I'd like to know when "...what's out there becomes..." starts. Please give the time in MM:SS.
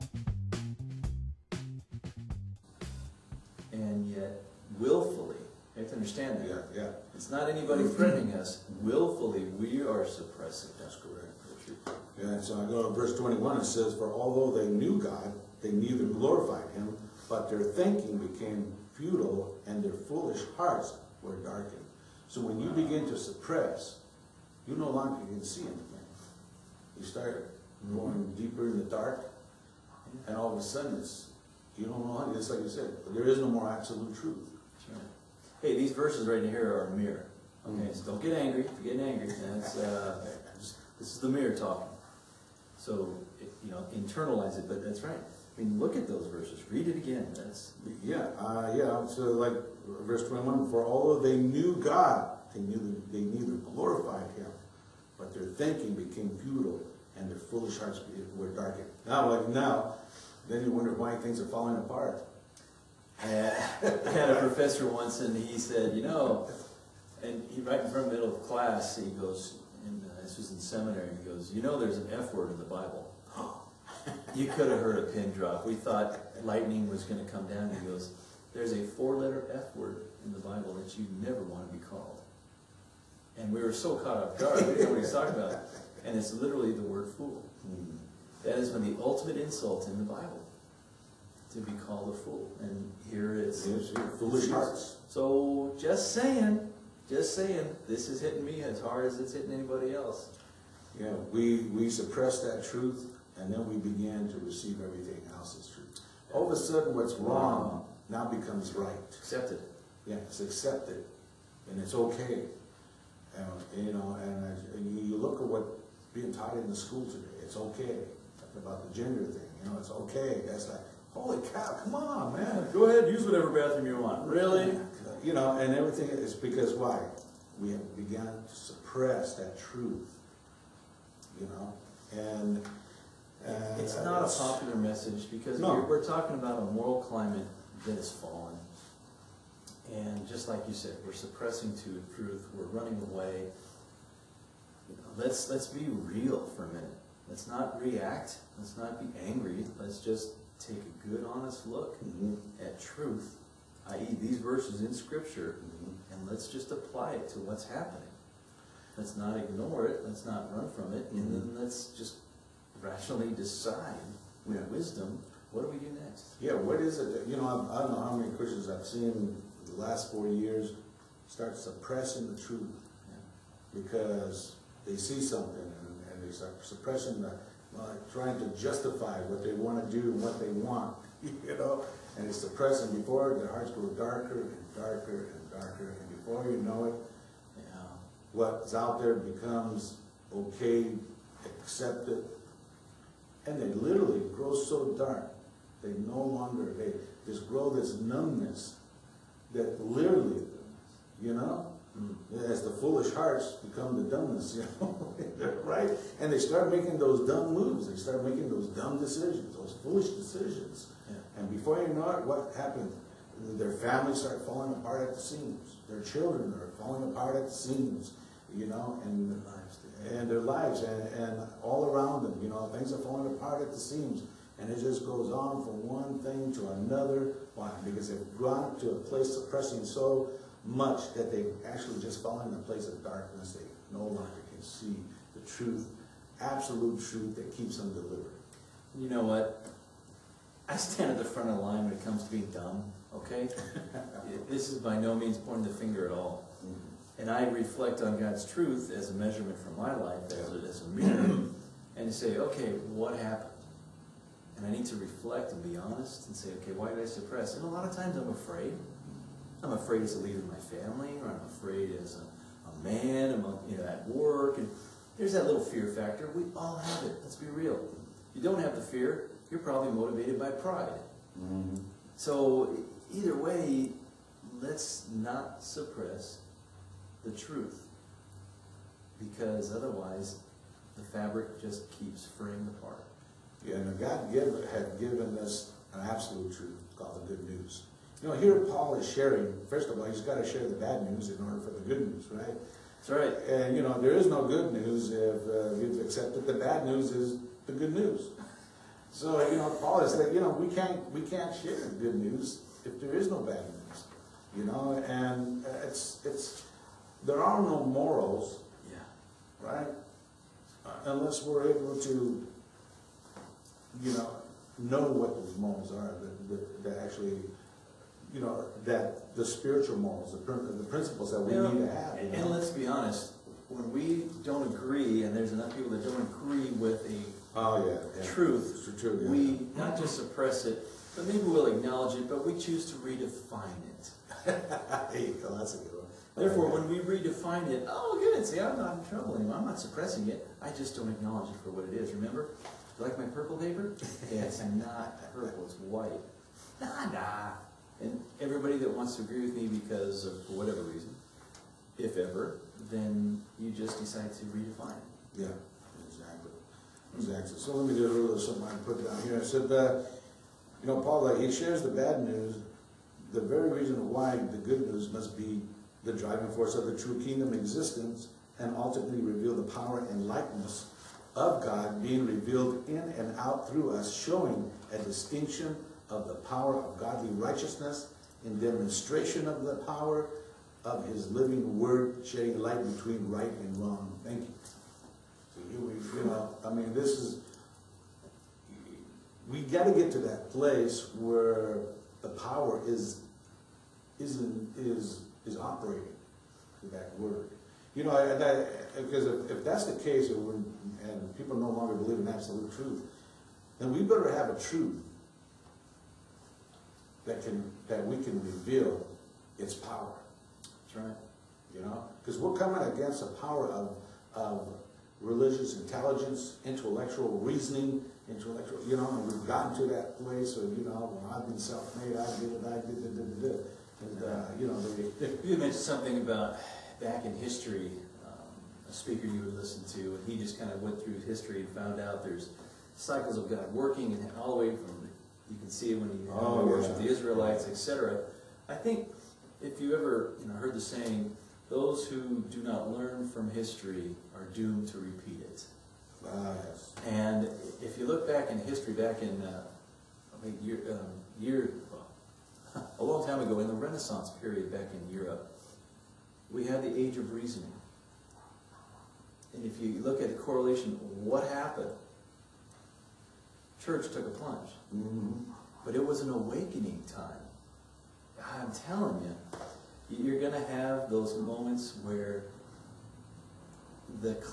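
03:08.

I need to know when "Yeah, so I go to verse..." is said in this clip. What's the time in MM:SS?
00:12.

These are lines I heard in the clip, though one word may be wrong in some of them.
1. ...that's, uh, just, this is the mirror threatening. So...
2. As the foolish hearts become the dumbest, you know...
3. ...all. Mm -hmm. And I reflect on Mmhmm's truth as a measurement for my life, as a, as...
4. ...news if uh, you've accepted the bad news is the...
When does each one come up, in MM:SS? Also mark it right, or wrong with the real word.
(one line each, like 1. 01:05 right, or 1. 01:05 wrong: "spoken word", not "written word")
1. 00:39 wrong: "talking", not "threatening"
2. 03:22 right
3. 04:06 wrong: "God", not "Mmhmm"
4. 04:54 right.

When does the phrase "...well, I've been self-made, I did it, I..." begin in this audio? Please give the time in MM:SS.
07:01.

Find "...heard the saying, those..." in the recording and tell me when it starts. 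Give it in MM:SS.
07:20.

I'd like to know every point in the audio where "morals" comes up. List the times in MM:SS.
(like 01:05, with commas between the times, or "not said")
02:16, 05:07, 05:15, 05:19.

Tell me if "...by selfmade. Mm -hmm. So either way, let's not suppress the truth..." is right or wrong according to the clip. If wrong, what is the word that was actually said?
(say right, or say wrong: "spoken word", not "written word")
wrong: "pride", not "selfmade".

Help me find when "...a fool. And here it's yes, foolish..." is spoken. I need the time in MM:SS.
01:32.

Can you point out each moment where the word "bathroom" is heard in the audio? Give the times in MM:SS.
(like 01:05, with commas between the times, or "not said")
02:03.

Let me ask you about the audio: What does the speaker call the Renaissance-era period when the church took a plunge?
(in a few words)
Age of Reasoning.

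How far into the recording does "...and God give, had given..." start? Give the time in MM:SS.
04:43.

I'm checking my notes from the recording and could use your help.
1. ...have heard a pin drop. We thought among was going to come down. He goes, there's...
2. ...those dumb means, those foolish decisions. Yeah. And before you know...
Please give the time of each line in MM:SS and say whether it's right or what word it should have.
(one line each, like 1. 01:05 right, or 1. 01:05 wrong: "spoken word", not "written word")
1. 01:14 wrong: "lightning", not "among"
2. 03:28 wrong: "decisions", not "means".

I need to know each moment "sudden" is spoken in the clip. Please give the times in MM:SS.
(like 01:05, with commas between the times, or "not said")
00:30, 01:46.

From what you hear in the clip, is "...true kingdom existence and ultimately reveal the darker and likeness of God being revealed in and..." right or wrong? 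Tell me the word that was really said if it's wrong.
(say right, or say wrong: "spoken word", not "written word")
wrong: "power", not "darker".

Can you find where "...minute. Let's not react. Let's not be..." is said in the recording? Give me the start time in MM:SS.
02:26.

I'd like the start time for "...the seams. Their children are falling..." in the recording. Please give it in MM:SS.
03:35.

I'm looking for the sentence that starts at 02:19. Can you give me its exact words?
And just like you said, we're suppressing to truth, we're running away.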